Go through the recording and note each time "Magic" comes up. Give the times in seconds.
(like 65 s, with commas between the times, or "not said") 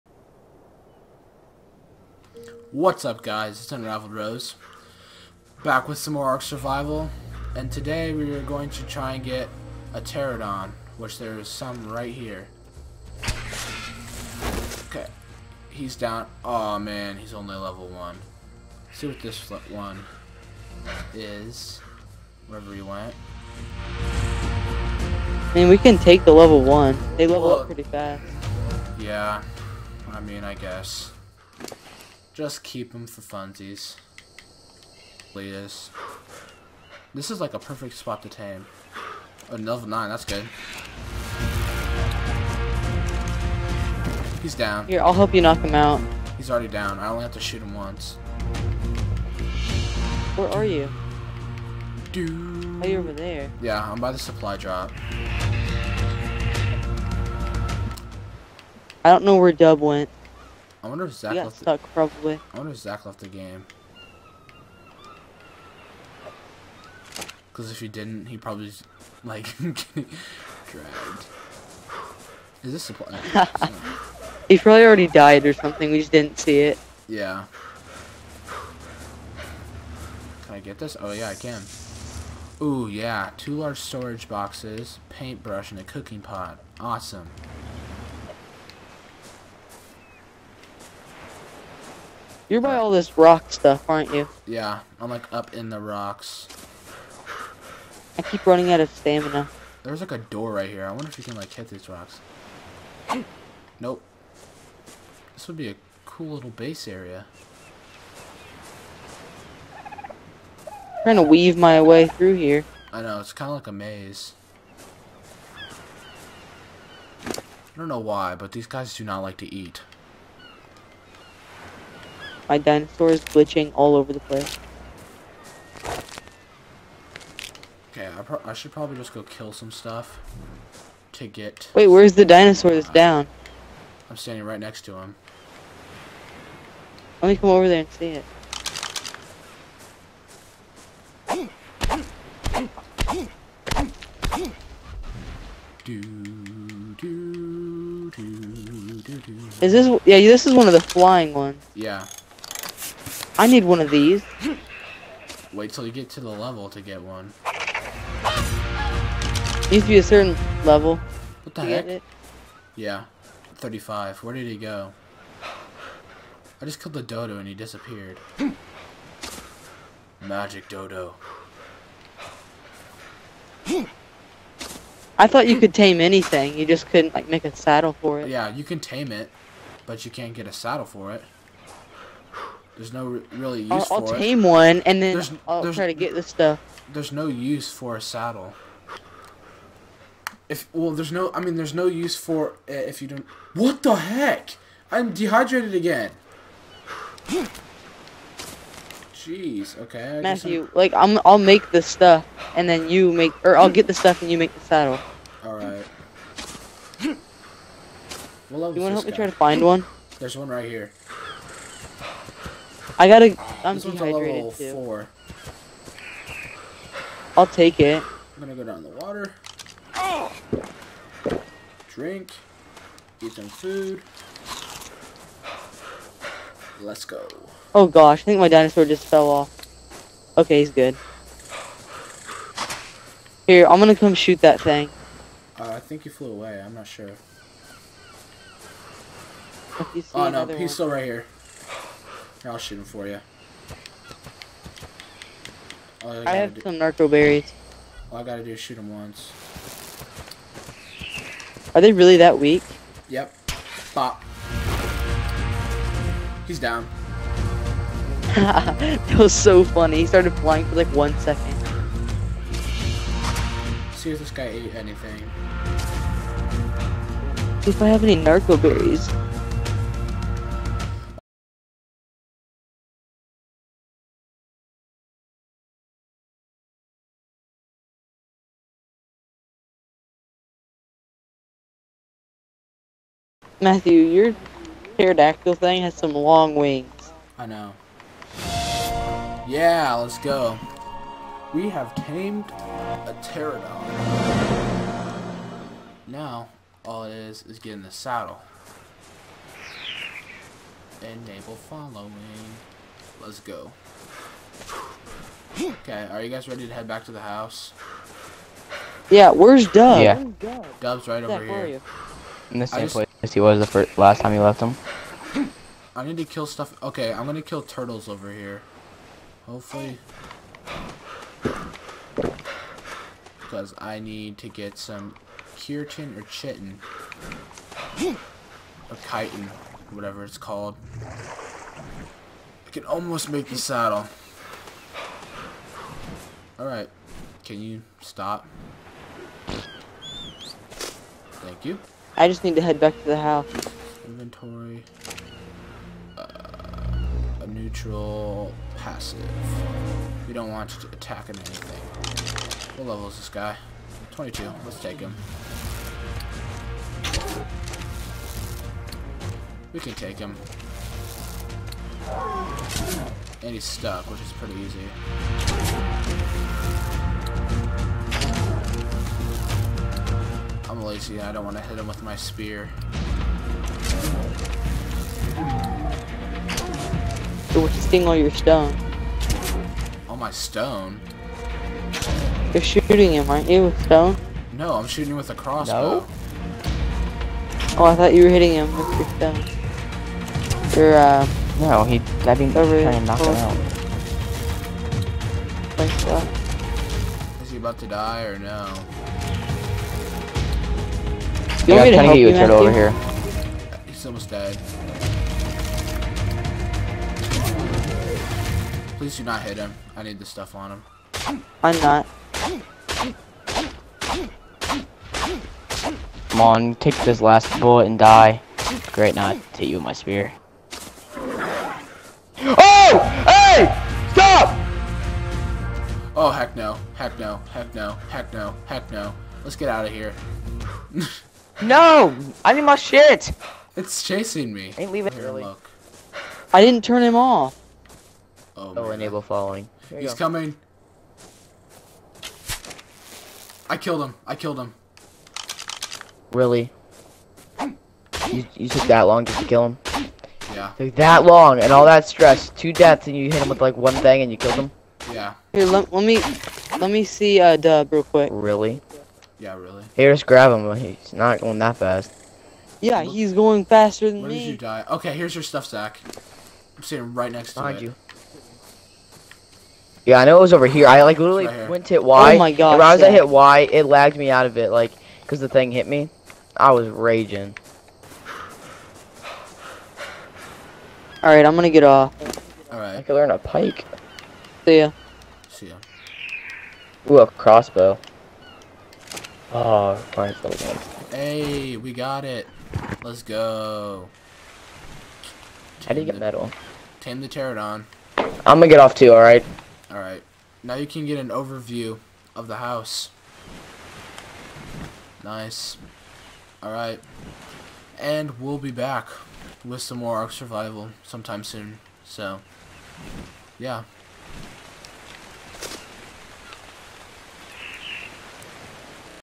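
170 s.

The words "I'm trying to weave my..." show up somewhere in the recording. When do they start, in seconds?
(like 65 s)
109 s.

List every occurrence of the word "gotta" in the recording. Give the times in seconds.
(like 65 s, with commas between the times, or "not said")
213 s, 248 s.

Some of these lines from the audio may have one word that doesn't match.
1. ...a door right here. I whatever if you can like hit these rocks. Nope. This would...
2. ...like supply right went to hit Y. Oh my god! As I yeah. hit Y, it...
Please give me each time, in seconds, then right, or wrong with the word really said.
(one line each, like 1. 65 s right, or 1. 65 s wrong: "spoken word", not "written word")
1. 100 s wrong: "wonder", not "whatever"
2. 471 s wrong: "literally", not "supply".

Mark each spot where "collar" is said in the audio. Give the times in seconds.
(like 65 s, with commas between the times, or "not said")
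not said.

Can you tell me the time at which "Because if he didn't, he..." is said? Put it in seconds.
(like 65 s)
67 s.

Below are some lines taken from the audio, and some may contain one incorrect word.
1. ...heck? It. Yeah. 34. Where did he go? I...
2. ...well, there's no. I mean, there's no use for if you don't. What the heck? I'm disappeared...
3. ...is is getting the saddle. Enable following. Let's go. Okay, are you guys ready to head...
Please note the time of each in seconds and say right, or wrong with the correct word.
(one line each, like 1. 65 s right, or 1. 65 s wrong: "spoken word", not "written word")
1. 161 s wrong: "35", not "34"
2. 190 s wrong: "dehydrated", not "disappeared"
3. 297 s right.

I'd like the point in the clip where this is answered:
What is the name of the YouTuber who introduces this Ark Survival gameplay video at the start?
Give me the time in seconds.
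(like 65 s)
3 s.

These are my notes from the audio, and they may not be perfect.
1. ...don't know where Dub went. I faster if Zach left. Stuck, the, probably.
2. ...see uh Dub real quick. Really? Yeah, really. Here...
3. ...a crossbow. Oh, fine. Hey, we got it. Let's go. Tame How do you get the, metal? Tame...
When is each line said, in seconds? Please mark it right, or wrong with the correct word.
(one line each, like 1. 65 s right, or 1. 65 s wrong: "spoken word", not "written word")
1. 59 s wrong: "wonder", not "faster"
2. 457 s right
3. 487 s right.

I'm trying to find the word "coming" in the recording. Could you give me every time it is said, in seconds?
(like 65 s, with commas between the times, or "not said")
440 s.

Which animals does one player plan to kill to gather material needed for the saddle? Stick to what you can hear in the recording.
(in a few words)
turtles.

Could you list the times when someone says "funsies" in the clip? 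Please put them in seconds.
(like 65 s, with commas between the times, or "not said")
33 s.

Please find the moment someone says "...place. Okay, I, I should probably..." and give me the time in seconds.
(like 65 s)
124 s.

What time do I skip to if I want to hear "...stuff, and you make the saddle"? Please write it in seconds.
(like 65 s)
203 s.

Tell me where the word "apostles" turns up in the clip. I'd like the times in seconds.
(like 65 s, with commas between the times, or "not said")
not said.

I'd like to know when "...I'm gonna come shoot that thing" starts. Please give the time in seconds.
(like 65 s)
233 s.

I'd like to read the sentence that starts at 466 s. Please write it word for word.
I'm sitting right next Behind to you.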